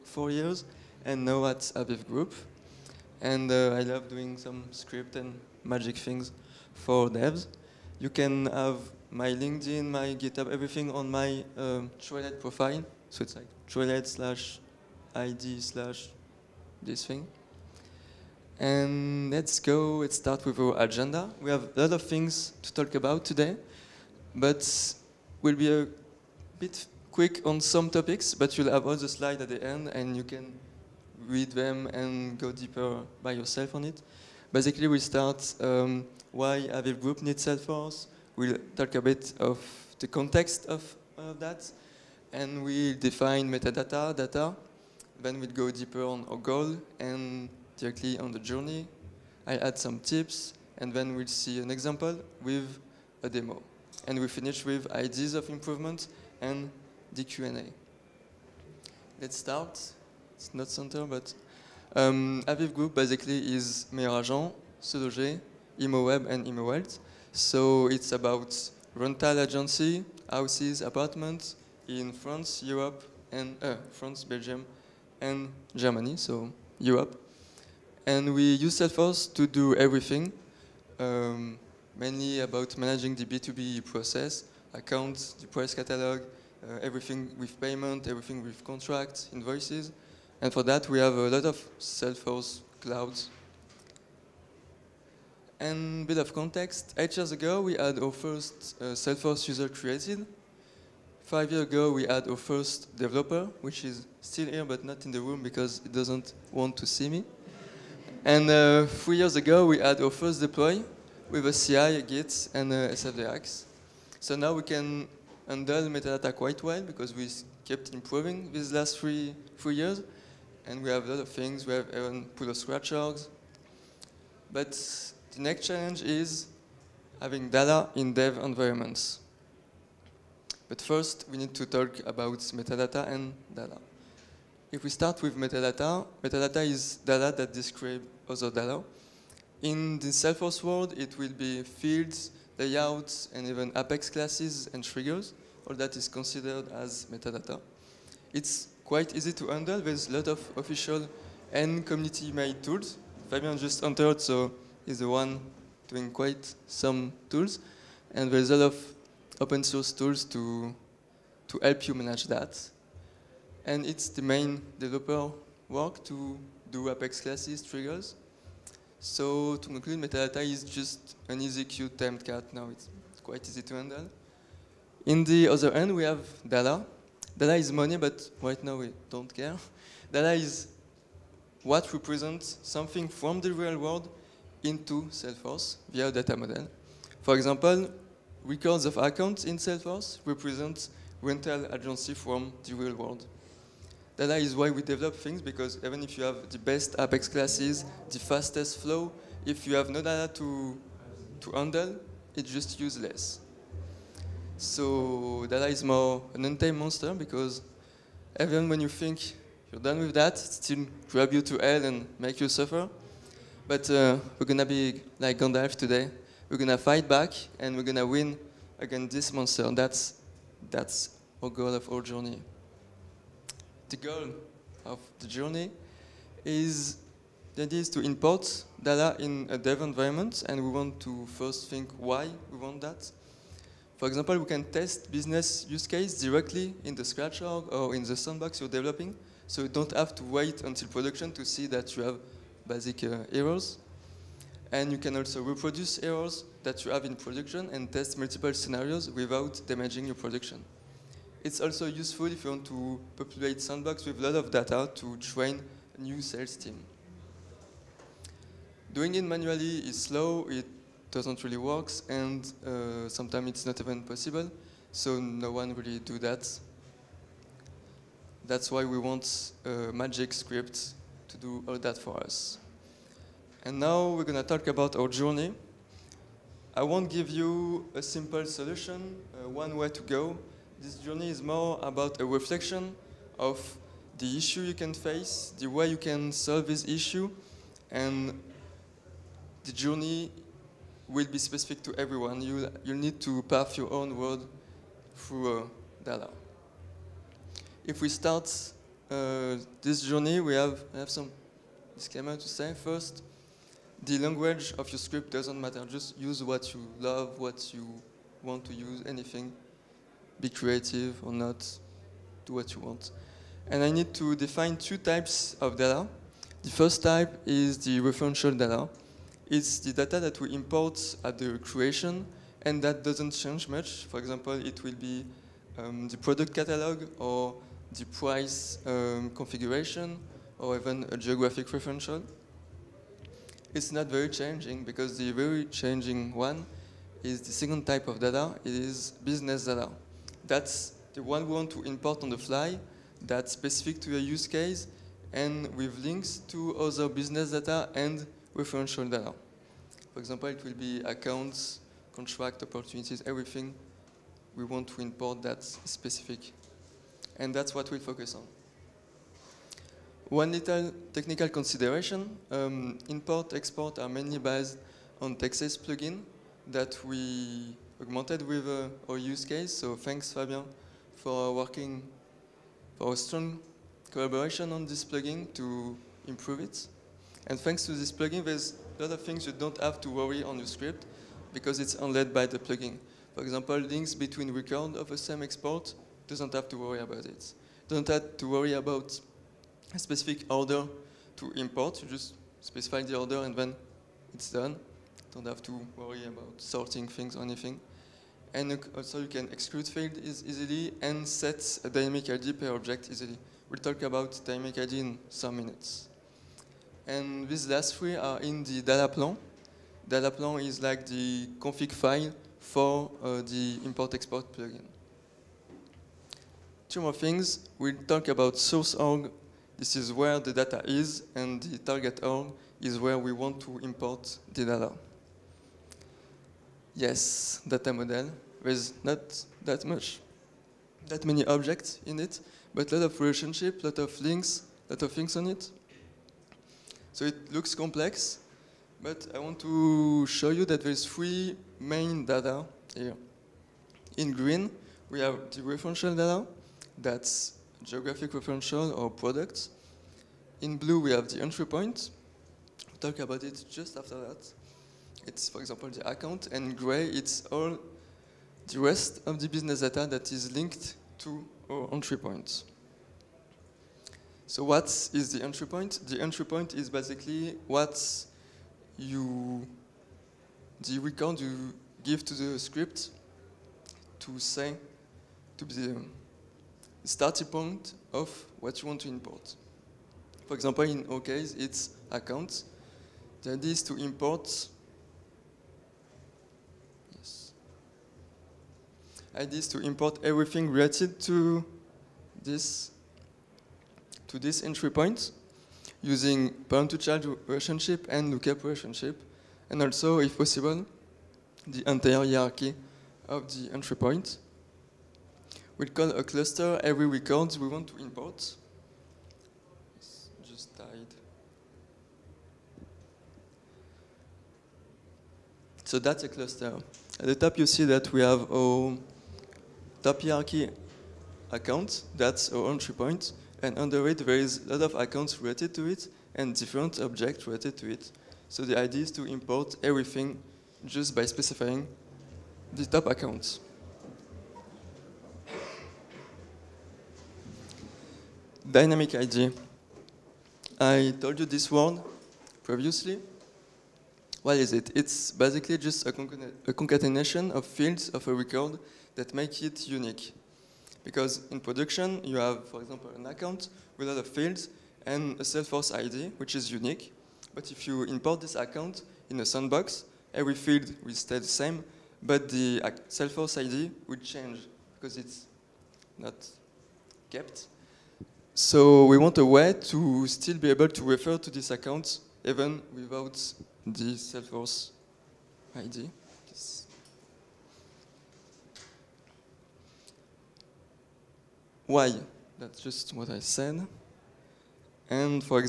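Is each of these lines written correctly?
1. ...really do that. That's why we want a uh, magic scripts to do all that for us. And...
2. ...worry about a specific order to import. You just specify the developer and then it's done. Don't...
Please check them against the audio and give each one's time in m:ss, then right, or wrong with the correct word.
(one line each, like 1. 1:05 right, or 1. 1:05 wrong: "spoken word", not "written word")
1. 4:25 right
2. 6:28 wrong: "order", not "developer".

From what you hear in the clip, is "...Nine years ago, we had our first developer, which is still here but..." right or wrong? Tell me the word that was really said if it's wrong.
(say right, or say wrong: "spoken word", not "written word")
wrong: "Five", not "Nine".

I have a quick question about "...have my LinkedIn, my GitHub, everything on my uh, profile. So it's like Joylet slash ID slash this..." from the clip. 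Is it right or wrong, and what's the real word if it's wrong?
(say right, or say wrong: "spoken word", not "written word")
right.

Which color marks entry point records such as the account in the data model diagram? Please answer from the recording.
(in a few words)
Blue.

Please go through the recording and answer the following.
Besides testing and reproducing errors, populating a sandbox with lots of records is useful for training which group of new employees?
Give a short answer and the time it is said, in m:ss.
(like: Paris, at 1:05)
A new sales team, at 4:16.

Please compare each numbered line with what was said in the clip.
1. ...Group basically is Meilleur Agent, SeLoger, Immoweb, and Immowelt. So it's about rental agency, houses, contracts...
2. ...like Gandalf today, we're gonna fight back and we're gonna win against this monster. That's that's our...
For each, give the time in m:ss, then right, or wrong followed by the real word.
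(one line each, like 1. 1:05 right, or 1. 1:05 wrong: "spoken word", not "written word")
1. 1:02 wrong: "apartments", not "contracts"
2. 3:35 right.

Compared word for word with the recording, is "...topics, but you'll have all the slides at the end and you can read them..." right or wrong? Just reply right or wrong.
right.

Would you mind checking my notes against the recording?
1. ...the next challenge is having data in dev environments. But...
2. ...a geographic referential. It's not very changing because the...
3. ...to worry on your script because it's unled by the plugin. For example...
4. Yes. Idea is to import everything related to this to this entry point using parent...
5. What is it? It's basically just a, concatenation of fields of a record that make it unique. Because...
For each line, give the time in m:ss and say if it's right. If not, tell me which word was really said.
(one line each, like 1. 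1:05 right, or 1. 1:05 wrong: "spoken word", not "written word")
1. 2:05 right
2. 5:31 right
3. 6:20 right
4. 8:07 right
5. 9:04 right.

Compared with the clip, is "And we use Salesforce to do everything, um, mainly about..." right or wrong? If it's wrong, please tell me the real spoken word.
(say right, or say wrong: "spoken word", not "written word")
right.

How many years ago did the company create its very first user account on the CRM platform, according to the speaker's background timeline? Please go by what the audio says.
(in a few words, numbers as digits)
8.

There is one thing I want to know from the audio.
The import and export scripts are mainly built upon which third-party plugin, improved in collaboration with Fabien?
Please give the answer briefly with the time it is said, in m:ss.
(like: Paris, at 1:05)
Texei plugin, at 6:05.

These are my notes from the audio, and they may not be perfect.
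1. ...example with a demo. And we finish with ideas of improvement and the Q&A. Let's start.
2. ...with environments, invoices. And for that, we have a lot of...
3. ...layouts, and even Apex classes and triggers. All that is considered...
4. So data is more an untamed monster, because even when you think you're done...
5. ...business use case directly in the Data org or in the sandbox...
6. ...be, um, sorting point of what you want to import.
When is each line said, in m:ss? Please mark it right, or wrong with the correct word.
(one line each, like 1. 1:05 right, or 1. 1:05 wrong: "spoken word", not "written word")
1. 0:51 right
2. 1:28 wrong: "contracts", not "environments"
3. 2:22 right
4. 3:24 right
5. 3:55 wrong: "Scratch", not "Data"
6. 7:55 wrong: "starting", not "sorting".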